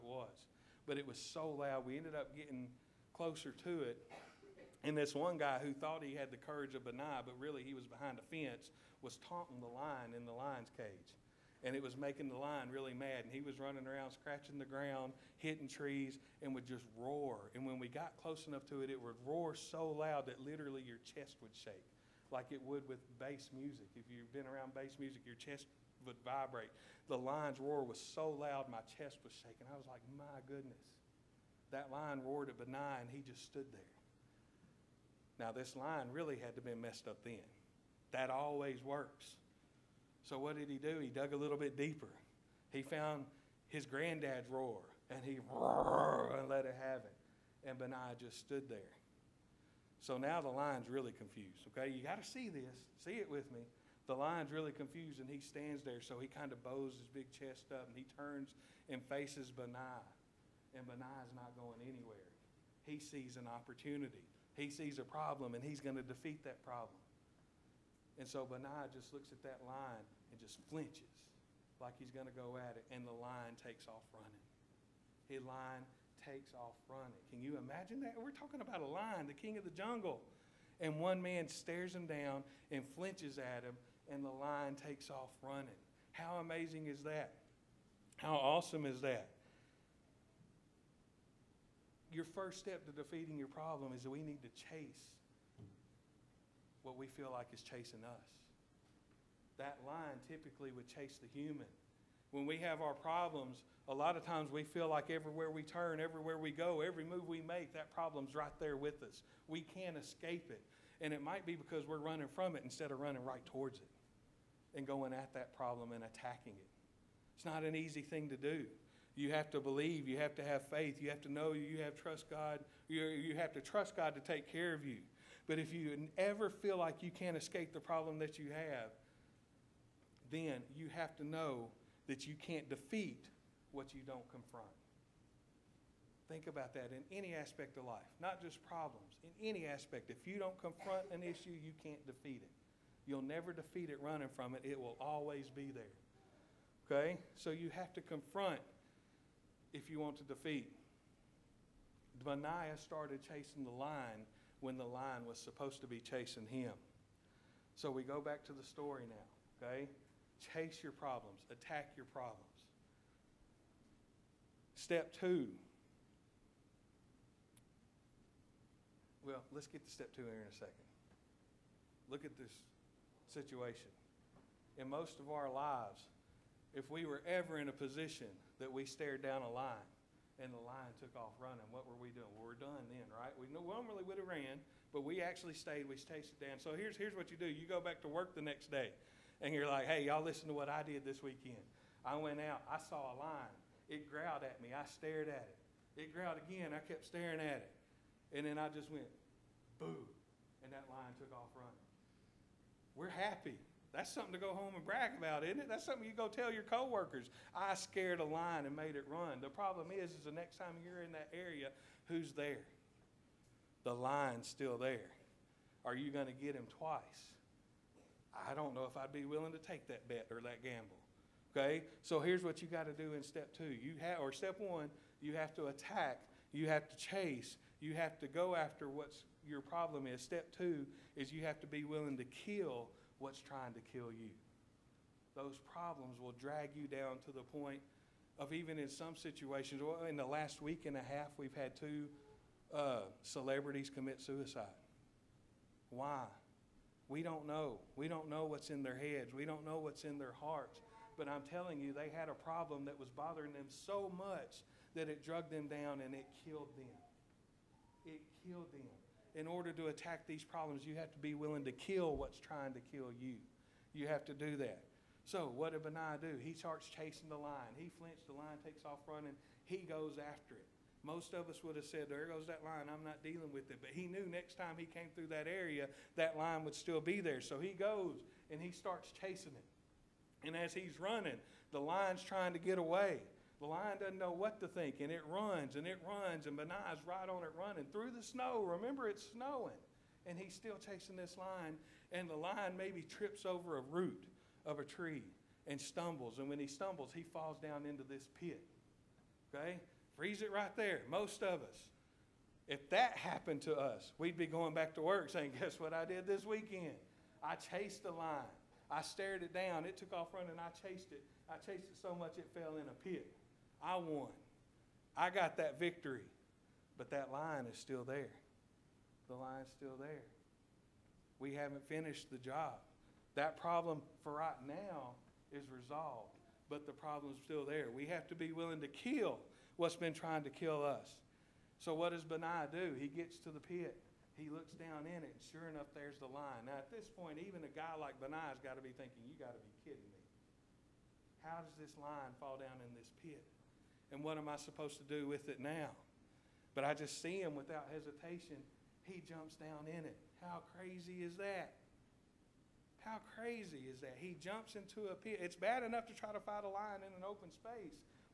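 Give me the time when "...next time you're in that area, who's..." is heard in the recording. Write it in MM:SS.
03:30.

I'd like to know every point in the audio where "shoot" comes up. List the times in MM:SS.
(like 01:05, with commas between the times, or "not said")
not said.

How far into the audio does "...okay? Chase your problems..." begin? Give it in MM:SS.
02:39.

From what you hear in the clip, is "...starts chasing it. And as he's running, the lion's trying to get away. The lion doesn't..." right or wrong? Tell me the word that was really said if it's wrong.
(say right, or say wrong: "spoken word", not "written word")
right.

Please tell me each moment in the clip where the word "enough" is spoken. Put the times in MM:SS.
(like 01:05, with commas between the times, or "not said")
00:18, 05:35, 05:55.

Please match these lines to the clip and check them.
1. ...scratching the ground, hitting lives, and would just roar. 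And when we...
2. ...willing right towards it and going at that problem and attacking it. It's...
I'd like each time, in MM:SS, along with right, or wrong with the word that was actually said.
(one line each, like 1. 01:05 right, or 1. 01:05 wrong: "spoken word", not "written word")
1. 00:14 wrong: "trees", not "lives"
2. 01:52 wrong: "running", not "willing".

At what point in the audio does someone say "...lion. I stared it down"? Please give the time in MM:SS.
05:08.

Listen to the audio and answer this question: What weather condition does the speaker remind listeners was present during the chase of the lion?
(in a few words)
Snow.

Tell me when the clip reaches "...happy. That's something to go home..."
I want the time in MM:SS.
03:23.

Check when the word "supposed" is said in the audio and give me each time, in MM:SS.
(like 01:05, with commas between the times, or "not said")
02:35, 05:44.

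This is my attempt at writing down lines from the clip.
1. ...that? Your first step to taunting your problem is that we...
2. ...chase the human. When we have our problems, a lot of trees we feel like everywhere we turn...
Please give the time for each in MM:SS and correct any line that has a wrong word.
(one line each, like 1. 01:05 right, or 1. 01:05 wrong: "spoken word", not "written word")
1. 01:29 wrong: "defeating", not "taunting"
2. 01:40 wrong: "times", not "trees".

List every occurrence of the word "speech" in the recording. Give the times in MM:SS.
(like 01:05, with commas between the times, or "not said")
not said.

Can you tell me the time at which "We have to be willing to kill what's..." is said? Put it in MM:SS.
05:27.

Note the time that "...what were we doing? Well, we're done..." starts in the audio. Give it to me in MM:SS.
03:01.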